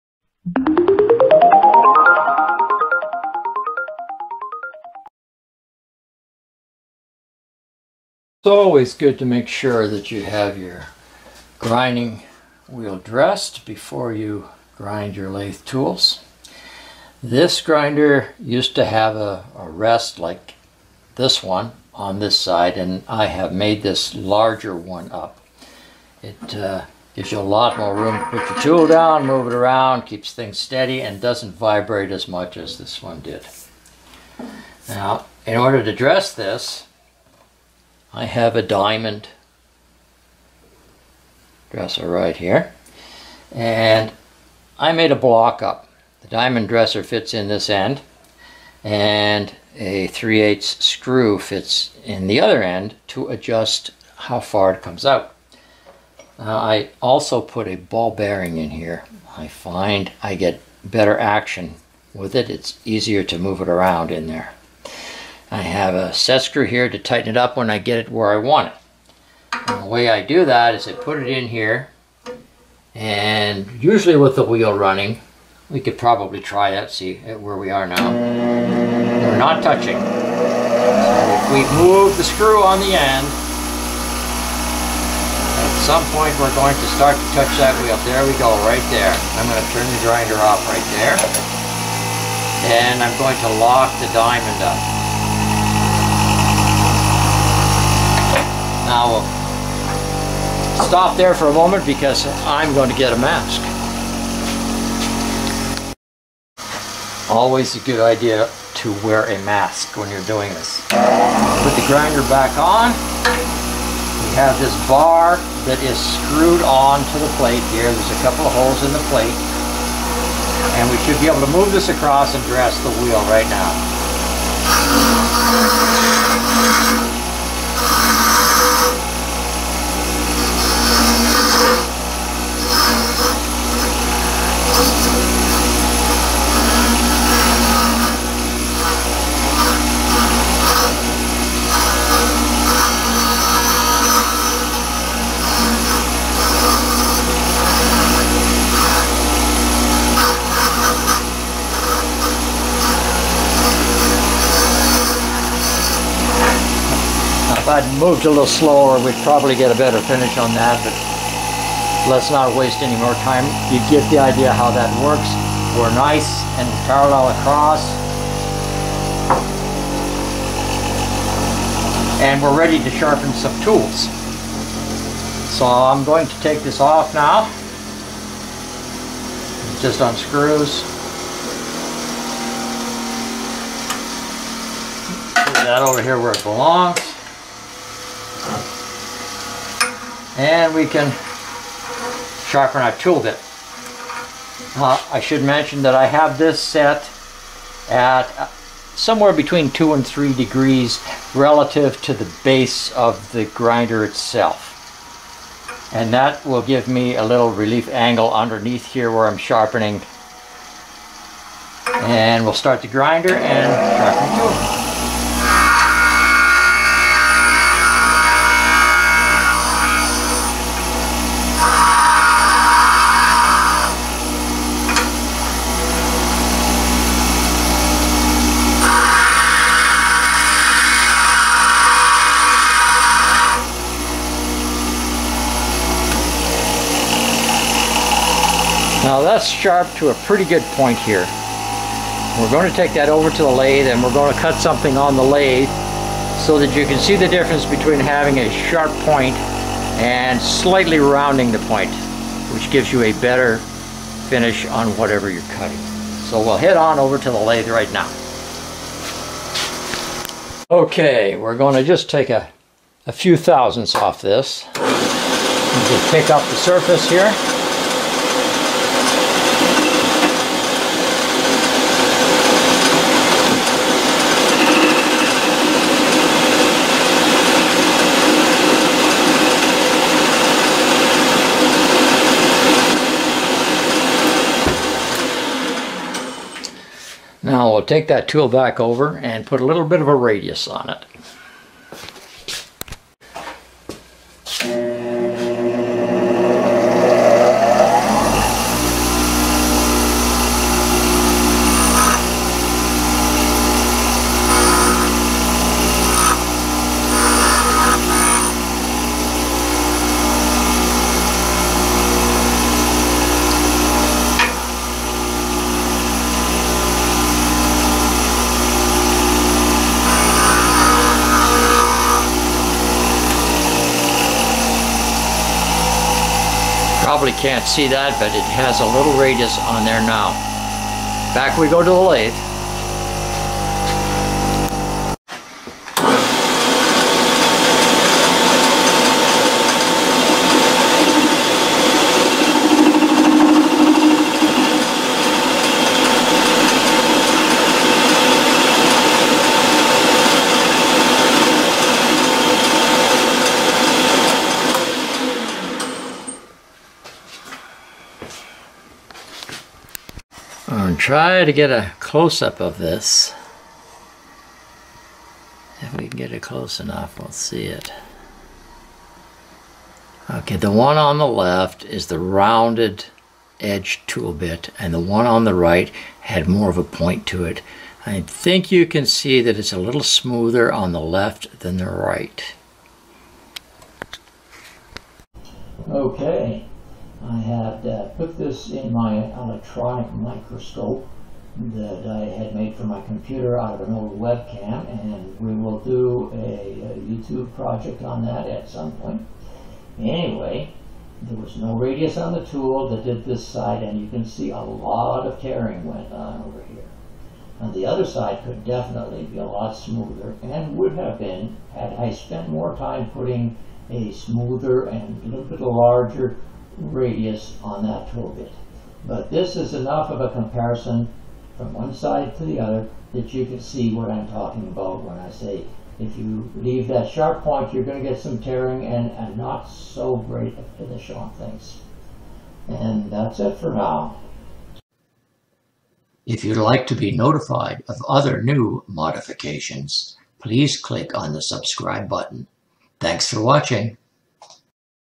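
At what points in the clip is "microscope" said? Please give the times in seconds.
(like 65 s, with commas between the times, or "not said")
390 s.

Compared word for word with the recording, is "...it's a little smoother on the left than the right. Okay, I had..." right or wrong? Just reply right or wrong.
right.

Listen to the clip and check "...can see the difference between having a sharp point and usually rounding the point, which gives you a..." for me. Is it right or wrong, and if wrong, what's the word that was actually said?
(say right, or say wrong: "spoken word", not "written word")
wrong: "slightly", not "usually".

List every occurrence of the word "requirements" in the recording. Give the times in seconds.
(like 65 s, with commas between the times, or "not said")
not said.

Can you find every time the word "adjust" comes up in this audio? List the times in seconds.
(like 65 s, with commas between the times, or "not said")
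53 s.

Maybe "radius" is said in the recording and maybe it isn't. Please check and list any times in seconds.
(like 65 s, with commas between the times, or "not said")
290 s, 329 s, 401 s, 416 s.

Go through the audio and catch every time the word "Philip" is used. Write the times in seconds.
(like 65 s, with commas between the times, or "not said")
not said.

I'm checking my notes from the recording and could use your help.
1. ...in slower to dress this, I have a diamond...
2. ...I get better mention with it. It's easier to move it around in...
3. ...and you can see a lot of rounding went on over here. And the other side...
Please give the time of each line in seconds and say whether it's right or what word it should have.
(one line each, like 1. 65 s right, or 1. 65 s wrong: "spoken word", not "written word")
1. 35 s wrong: "order", not "slower"
2. 60 s wrong: "action", not "mention"
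3. 403 s wrong: "tearing", not "rounding".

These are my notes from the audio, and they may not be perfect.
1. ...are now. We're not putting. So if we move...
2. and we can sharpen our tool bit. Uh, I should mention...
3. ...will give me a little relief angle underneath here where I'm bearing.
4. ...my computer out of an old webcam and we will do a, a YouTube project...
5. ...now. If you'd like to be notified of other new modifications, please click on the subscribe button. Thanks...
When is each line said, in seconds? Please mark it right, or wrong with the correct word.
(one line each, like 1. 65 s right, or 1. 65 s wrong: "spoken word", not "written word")
1. 77 s wrong: "touching", not "putting"
2. 190 s right
3. 206 s wrong: "sharpening", not "bearing"
4. 392 s right
5. 433 s right.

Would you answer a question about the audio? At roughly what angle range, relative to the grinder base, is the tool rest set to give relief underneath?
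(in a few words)
2 to 3 degrees.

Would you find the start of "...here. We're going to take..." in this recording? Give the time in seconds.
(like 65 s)
240 s.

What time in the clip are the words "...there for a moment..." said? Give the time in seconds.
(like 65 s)
101 s.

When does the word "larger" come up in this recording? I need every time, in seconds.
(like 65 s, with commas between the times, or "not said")
24 s, 415 s.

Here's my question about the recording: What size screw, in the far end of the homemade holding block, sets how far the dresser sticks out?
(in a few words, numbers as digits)
3/8.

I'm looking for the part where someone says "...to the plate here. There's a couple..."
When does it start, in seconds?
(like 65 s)
117 s.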